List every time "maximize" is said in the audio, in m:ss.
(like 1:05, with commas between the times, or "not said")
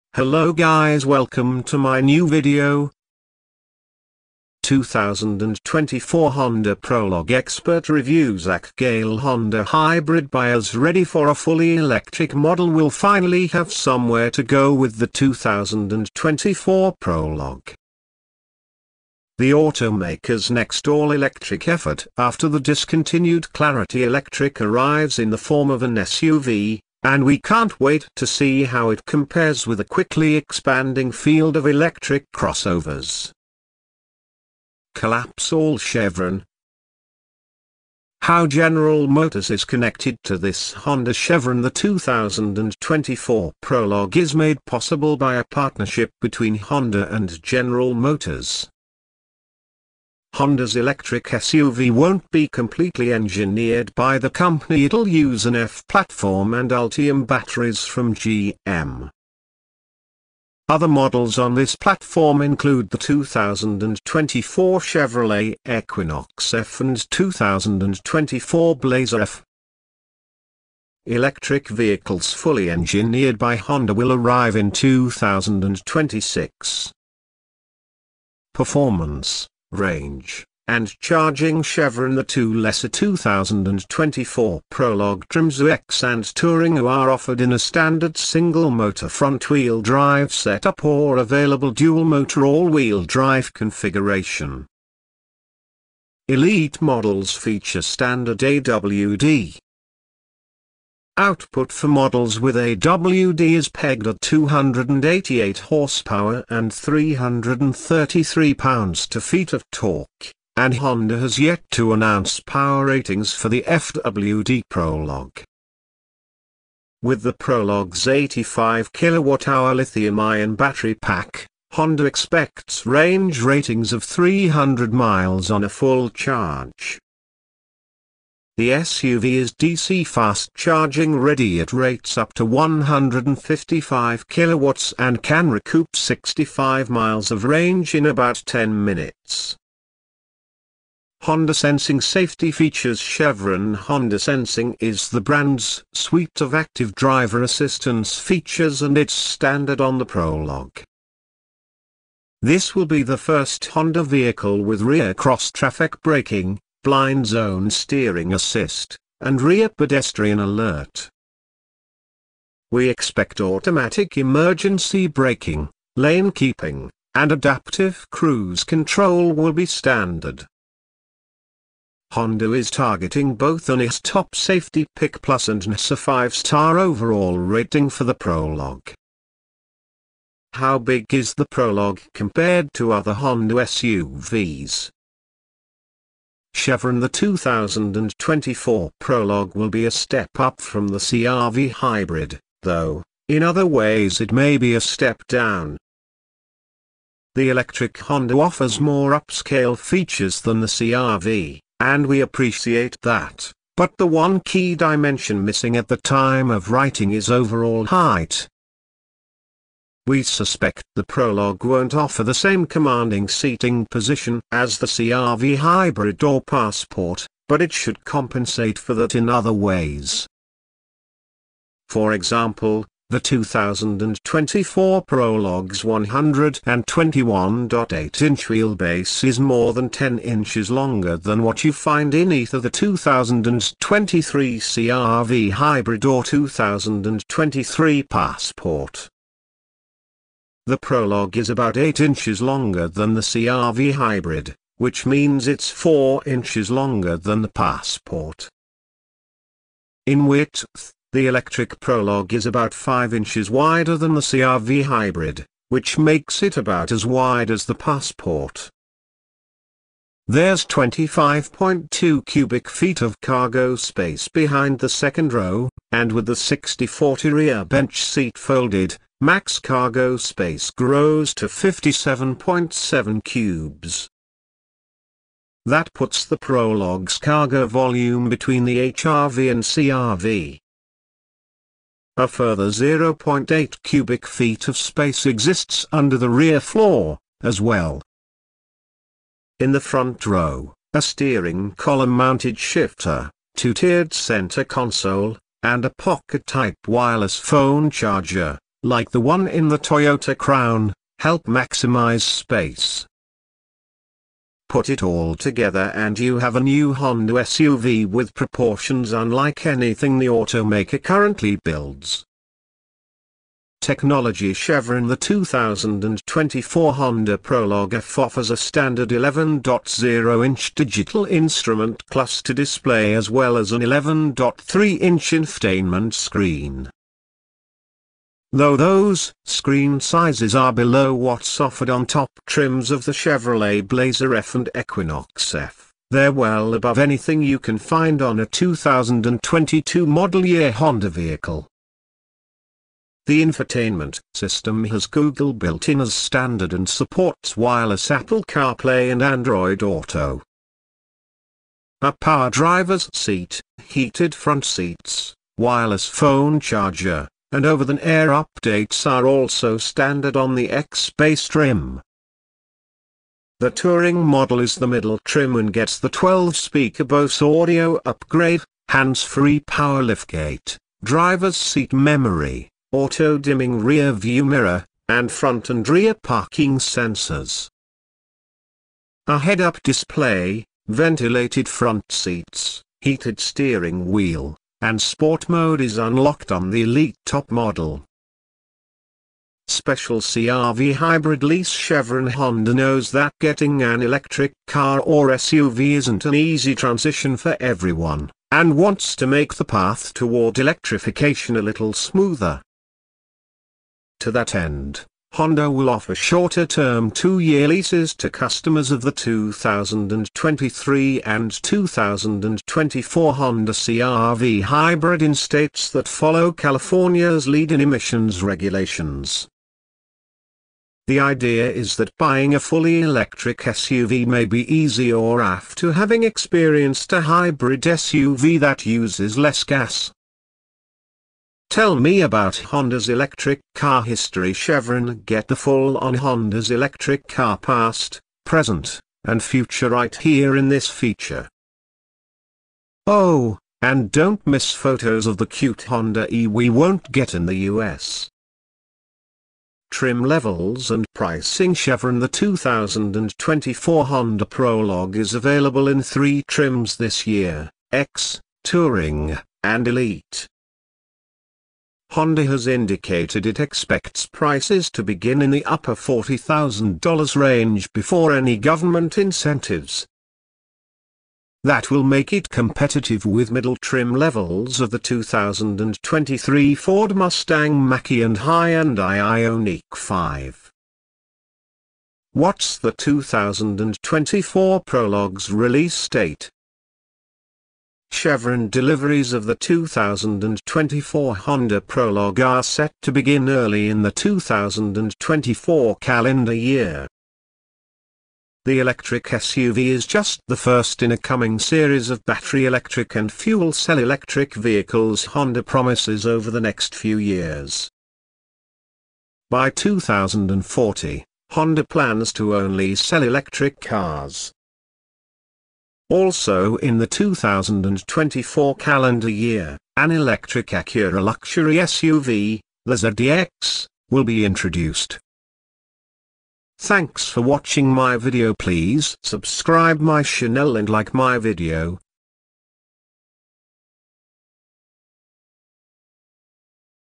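5:01.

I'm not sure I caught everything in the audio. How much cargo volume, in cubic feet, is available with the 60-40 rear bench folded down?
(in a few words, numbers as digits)
57.7.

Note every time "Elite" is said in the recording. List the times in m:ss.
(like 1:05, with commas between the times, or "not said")
1:36, 6:26, 7:39.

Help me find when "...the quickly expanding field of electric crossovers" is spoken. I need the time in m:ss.
0:29.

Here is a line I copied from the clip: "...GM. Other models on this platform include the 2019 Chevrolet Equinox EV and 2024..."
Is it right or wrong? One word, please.
wrong.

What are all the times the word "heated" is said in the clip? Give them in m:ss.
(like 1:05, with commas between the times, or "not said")
5:53, 6:23.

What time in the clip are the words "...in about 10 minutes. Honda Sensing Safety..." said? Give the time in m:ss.
2:17.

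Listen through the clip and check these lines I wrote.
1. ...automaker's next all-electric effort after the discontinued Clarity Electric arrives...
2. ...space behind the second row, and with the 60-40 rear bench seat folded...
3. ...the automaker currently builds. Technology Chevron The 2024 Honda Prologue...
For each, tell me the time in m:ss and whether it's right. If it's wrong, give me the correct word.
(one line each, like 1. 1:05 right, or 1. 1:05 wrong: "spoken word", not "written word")
1. 0:19 right
2. 4:23 right
3. 5:10 right.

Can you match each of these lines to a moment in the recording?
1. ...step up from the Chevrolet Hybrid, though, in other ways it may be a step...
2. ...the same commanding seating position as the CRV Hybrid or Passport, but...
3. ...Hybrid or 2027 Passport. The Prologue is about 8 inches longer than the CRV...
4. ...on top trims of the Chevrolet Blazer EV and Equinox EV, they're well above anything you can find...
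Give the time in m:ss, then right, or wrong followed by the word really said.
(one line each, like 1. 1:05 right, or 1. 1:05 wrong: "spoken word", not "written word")
1. 3:09 wrong: "CRV", not "Chevrolet"
2. 3:32 right
3. 3:55 wrong: "2023", not "2027"
4. 5:31 right.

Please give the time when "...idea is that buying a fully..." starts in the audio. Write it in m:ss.
7:01.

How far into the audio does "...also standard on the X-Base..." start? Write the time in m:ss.
5:59.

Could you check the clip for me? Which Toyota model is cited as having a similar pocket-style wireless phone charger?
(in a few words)
Toyota Crown.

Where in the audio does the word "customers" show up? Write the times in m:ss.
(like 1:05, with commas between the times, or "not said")
6:48.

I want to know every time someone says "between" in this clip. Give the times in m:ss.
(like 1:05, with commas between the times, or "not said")
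0:46, 4:38.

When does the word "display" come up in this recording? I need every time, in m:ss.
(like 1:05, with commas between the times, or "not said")
5:22, 6:19.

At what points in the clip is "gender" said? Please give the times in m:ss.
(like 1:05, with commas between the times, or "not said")
not said.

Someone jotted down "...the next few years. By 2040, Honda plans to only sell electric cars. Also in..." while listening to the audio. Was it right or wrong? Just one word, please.
right.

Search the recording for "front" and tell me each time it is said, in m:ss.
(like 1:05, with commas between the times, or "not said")
1:29, 4:49, 5:54, 6:15, 6:21.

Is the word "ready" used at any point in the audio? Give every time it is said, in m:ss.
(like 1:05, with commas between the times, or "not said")
0:10, 2:11.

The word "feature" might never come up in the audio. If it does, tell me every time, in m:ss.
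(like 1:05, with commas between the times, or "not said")
1:37, 2:22, 2:28, 3:19, 7:20.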